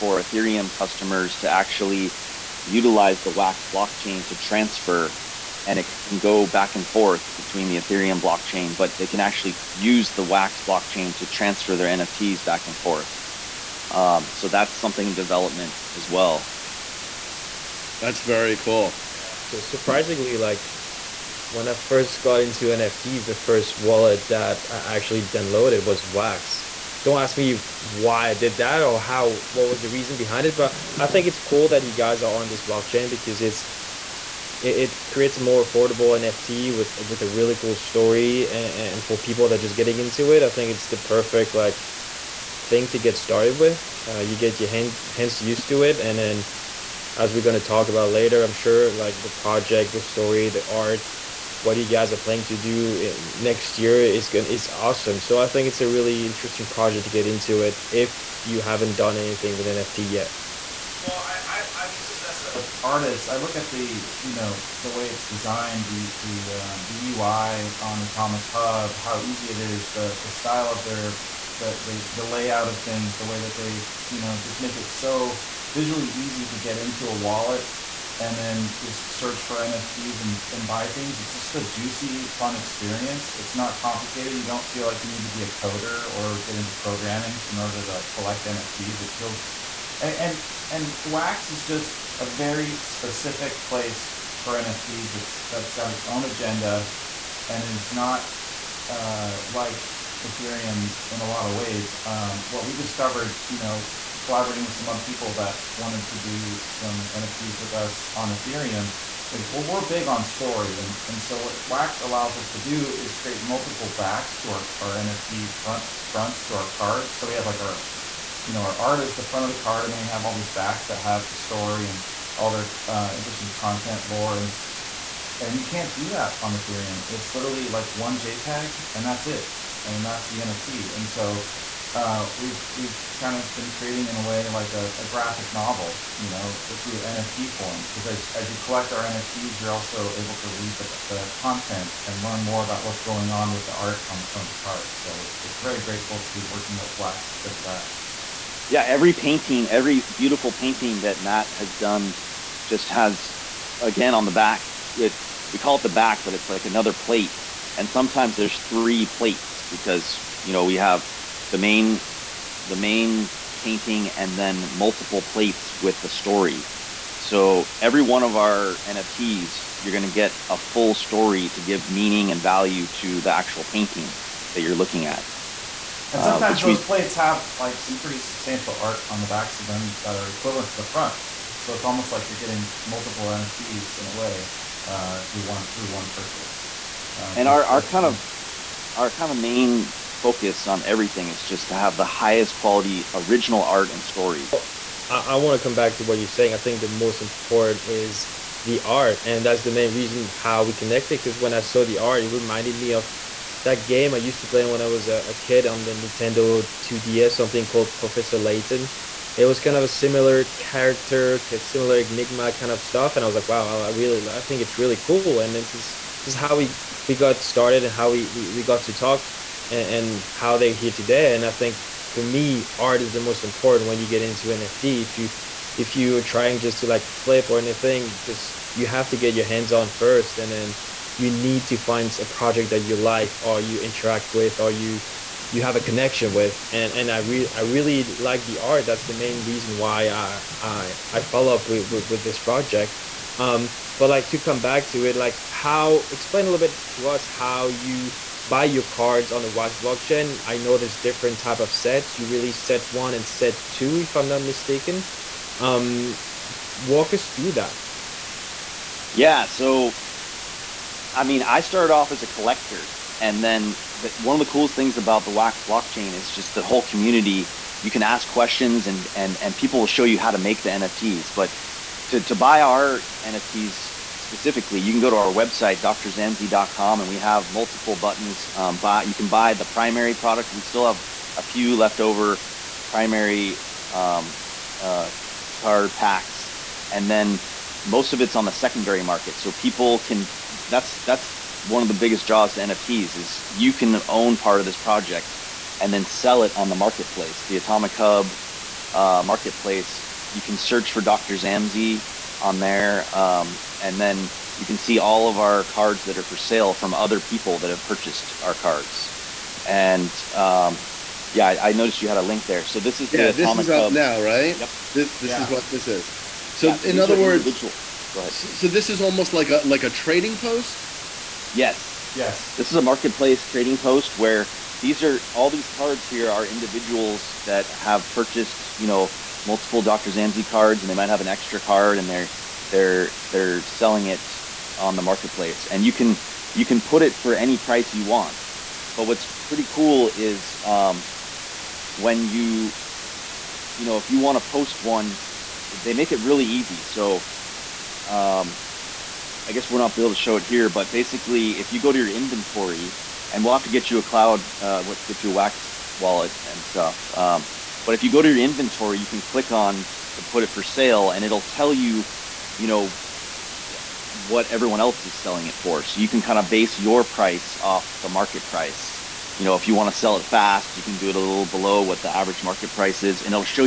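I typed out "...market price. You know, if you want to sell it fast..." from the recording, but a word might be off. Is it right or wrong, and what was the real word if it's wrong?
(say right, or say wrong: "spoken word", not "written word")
right.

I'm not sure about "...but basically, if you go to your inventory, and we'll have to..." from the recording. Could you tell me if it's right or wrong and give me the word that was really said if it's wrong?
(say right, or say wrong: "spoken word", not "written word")
right.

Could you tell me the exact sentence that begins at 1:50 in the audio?
And, and so what Wax allows us to do is create multiple backs to our, our NFT front fronts to our cards.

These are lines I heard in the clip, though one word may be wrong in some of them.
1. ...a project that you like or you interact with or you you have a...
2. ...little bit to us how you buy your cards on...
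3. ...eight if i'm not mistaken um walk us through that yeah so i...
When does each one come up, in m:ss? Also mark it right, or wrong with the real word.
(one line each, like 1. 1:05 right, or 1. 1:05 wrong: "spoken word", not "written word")
1. 3:52 right
2. 4:06 right
3. 4:13 wrong: "two", not "eight".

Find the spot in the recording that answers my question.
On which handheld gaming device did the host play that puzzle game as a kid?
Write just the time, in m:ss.
3:25.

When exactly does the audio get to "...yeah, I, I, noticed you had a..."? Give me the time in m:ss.
5:11.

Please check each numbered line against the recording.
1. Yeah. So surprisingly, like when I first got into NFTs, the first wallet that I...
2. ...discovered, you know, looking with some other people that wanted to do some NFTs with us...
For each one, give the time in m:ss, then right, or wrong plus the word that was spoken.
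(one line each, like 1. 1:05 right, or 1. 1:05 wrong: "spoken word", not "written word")
1. 0:19 right
2. 1:42 wrong: "collaborating", not "looking".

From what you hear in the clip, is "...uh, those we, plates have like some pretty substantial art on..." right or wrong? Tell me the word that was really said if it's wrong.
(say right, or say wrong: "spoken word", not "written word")
right.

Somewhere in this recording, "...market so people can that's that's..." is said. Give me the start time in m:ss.
4:49.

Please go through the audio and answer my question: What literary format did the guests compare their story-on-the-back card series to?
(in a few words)
A graphic novel.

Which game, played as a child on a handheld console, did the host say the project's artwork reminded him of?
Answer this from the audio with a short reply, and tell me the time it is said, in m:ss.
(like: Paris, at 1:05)
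Professor Layton, at 3:27.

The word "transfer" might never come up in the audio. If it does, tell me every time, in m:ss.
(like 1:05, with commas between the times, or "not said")
0:04, 0:11.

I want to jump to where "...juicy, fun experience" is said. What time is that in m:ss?
1:21.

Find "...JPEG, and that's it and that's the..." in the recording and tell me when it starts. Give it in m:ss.
2:08.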